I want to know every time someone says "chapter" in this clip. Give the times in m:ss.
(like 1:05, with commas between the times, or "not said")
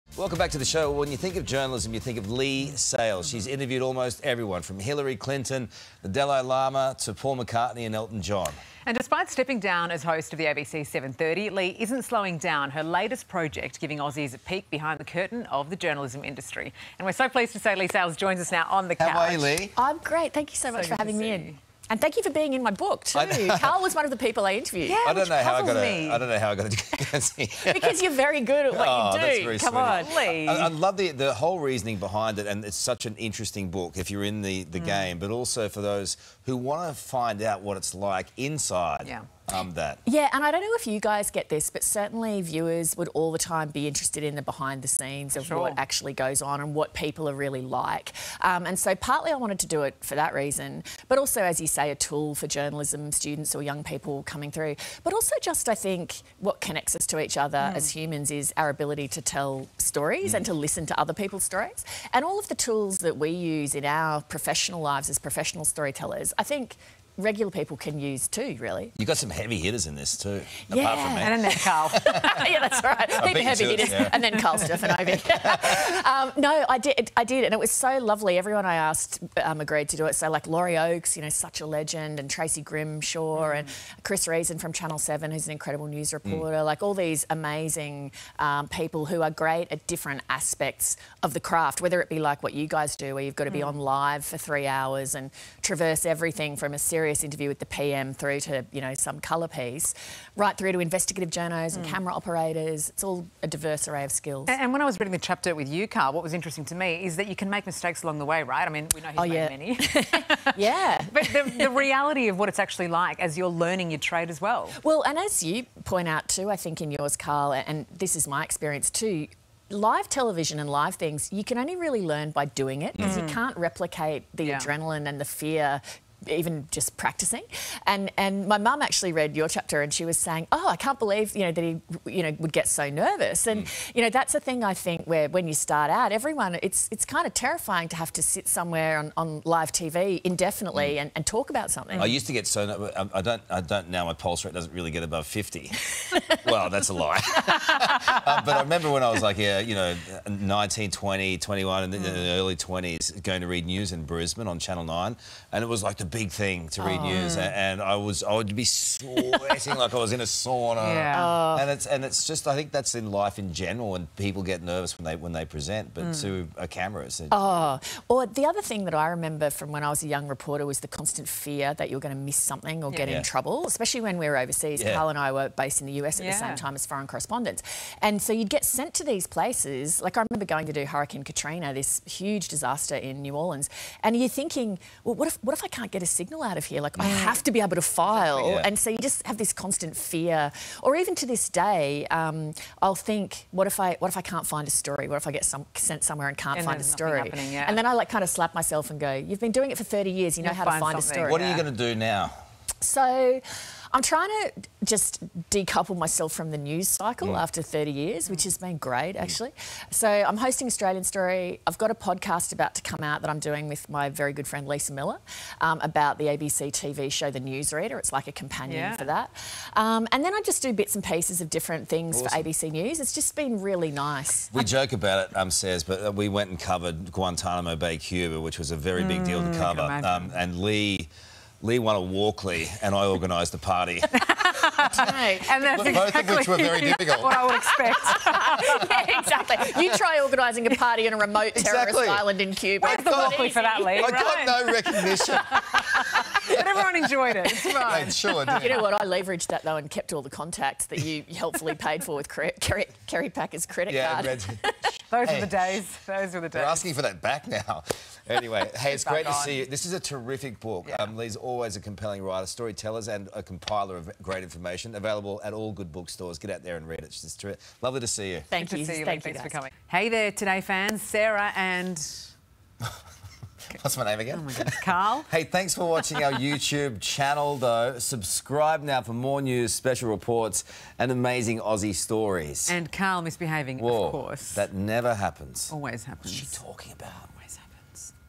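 1:45, 2:09.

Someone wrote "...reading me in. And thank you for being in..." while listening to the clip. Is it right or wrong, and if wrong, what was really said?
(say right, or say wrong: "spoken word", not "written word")
wrong: "having", not "reading".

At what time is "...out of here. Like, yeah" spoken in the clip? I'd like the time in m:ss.
3:06.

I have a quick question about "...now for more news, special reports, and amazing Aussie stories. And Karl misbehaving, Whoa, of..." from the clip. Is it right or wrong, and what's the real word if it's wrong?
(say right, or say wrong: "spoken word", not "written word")
right.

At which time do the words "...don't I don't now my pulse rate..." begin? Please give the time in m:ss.
2:23.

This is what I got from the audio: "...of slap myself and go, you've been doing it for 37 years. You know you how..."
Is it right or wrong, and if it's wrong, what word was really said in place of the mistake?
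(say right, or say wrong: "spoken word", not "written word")
wrong: "30", not "37".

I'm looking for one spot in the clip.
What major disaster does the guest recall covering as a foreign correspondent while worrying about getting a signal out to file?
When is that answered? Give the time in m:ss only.
3:00.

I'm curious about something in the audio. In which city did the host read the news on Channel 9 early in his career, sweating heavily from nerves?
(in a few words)
Brisbane.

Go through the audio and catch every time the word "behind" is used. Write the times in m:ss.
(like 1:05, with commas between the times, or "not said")
0:14, 0:31, 0:44.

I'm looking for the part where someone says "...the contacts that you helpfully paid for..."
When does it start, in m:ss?
4:10.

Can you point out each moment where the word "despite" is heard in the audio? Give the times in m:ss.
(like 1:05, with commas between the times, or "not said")
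0:08.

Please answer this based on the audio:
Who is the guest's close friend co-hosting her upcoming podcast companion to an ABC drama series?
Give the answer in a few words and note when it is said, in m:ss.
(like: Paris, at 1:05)
Lisa Miller, at 3:34.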